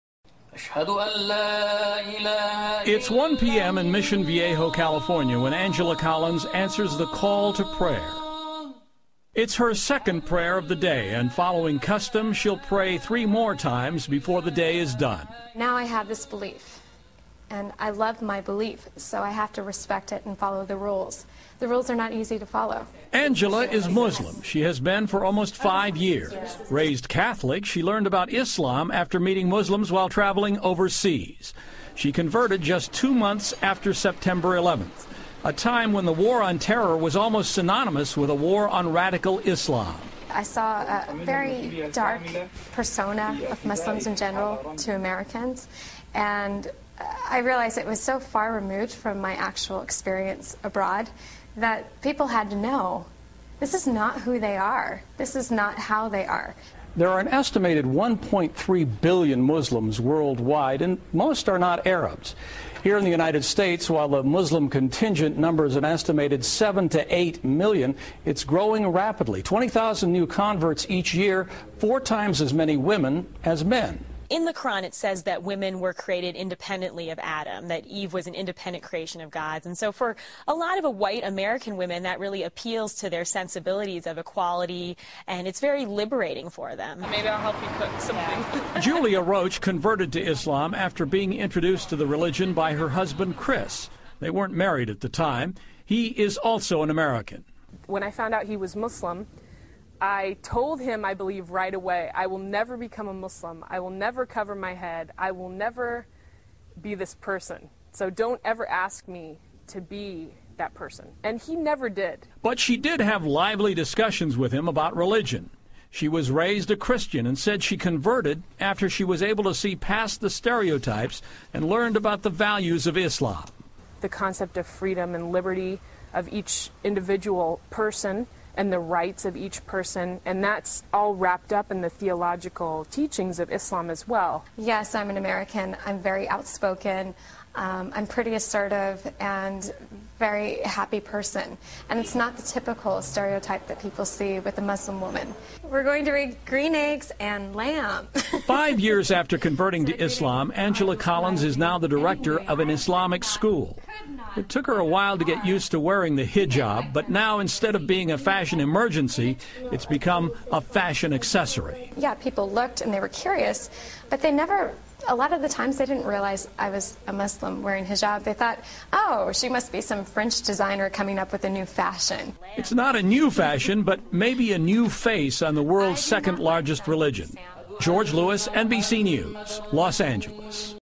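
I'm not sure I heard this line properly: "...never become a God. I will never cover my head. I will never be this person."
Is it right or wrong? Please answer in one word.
wrong.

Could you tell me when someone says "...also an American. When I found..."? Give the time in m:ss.
1:36.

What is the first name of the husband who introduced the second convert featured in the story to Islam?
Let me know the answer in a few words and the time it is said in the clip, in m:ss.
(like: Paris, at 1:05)
Chris, at 1:33.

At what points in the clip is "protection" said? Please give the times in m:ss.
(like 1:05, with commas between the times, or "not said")
not said.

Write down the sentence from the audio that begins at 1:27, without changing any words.
Maybe I'll help you cook something.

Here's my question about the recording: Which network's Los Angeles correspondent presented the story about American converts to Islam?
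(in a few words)
NBC News.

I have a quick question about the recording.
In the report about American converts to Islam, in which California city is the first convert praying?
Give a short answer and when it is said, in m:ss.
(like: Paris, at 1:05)
Mission Viejo, at 0:03.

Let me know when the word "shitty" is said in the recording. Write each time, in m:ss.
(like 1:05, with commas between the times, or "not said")
not said.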